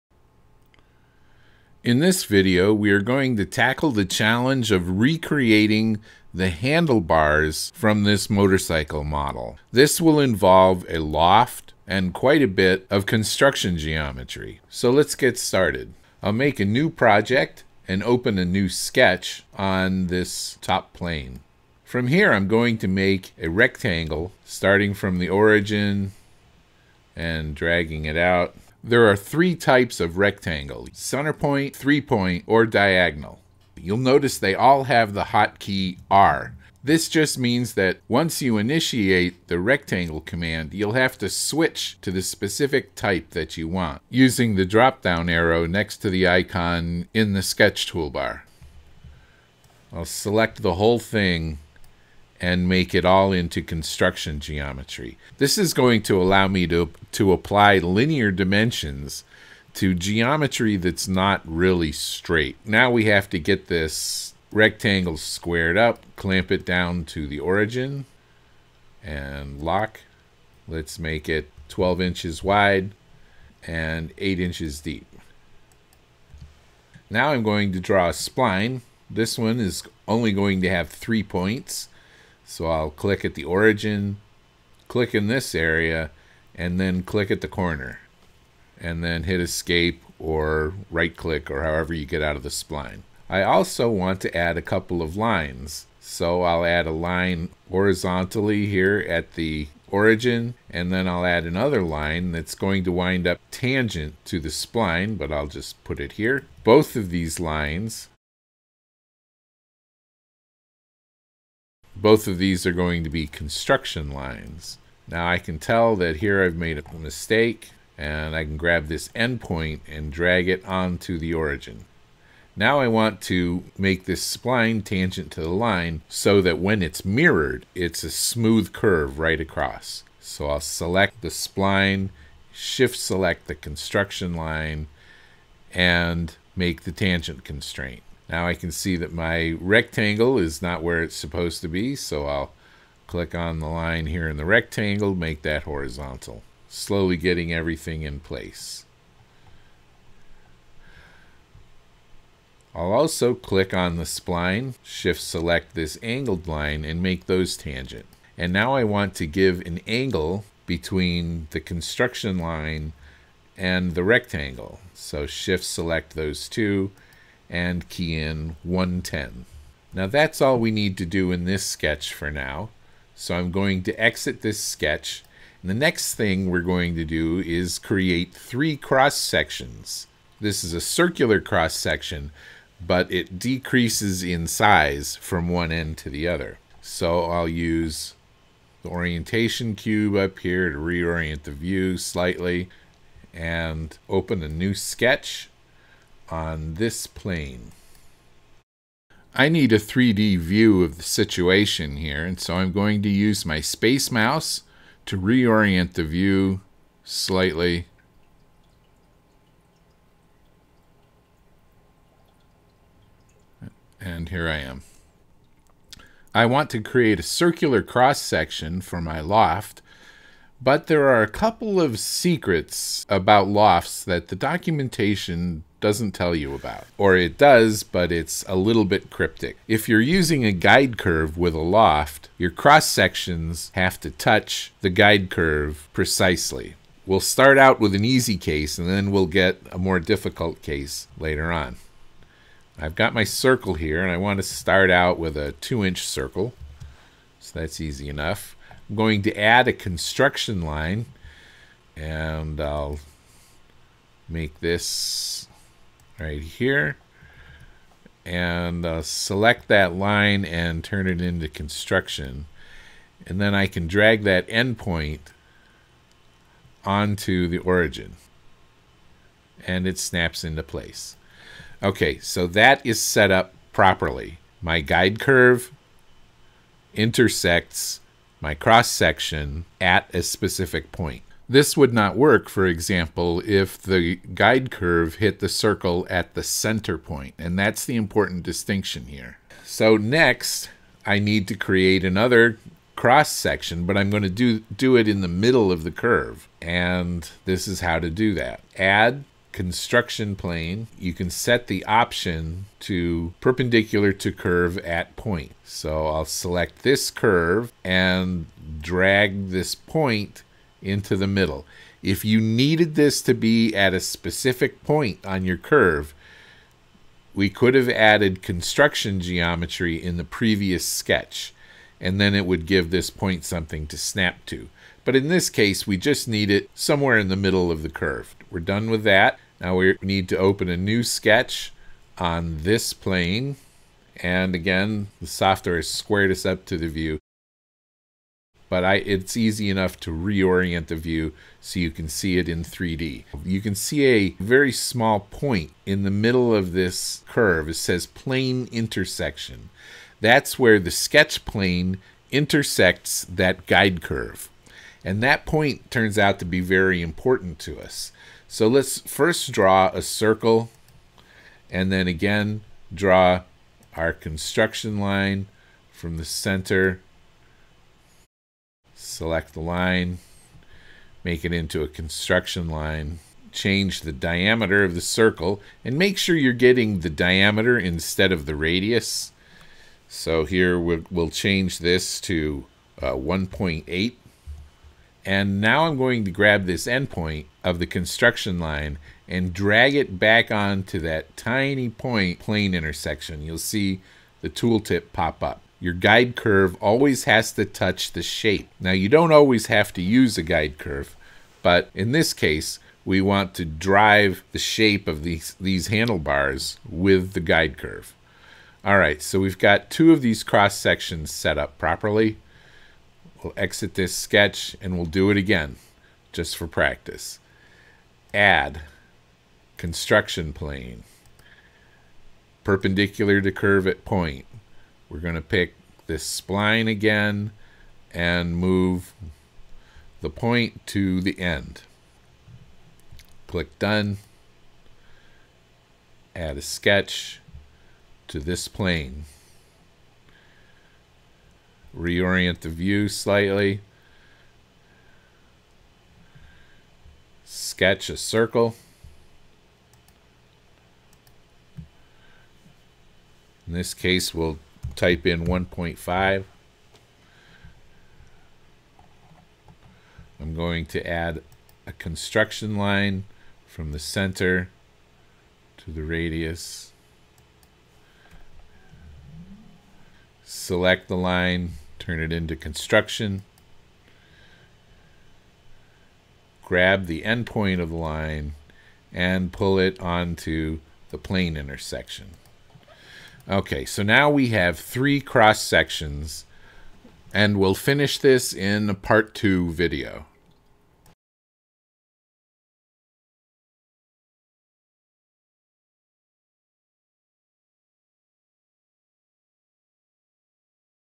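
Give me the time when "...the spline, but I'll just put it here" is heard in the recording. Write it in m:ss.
1:44.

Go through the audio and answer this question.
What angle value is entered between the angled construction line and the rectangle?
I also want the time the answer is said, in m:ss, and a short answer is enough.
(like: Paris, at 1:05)
110, at 2:48.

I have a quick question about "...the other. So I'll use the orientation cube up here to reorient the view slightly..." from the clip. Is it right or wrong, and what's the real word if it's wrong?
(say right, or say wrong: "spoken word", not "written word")
right.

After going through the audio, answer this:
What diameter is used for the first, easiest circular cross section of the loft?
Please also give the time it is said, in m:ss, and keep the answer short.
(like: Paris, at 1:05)
2 inches, at 4:05.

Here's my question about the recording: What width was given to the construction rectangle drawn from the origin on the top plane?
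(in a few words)
12 inches.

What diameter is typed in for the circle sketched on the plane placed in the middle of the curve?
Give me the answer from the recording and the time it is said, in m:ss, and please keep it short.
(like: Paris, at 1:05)
1.8, at 6:23.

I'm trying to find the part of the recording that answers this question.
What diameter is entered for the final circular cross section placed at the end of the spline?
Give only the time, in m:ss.
7:35.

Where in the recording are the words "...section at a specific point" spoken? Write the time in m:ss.
4:38.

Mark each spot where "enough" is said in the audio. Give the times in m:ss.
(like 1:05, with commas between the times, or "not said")
4:08, 5:39.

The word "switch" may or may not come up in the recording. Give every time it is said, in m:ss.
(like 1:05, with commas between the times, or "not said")
0:41.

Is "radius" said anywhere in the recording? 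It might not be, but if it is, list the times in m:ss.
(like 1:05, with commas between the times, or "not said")
6:18, 7:46.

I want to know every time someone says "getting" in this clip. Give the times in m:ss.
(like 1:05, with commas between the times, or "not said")
2:27, 6:16.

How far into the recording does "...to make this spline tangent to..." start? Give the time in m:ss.
2:03.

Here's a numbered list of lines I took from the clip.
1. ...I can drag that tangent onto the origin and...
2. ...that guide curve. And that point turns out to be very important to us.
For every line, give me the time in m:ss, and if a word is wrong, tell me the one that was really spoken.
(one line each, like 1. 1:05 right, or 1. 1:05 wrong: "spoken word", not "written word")
1. 4:23 wrong: "endpoint", not "tangent"
2. 5:53 right.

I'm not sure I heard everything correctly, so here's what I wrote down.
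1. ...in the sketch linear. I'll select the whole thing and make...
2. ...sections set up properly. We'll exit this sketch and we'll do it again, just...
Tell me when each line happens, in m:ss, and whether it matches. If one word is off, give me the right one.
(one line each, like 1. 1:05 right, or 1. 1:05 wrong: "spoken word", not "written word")
1. 0:47 wrong: "toolbar", not "linear"
2. 6:50 right.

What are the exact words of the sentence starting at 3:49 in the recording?
If you're using a guide curve with a loft, your cross sections have to touch the guide curve precisely.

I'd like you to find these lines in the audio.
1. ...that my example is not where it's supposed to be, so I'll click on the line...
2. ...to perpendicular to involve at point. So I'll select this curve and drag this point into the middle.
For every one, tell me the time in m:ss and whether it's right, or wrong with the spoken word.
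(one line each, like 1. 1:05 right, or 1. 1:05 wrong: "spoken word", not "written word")
1. 2:18 wrong: "rectangle", not "example"
2. 5:02 wrong: "curve", not "involve".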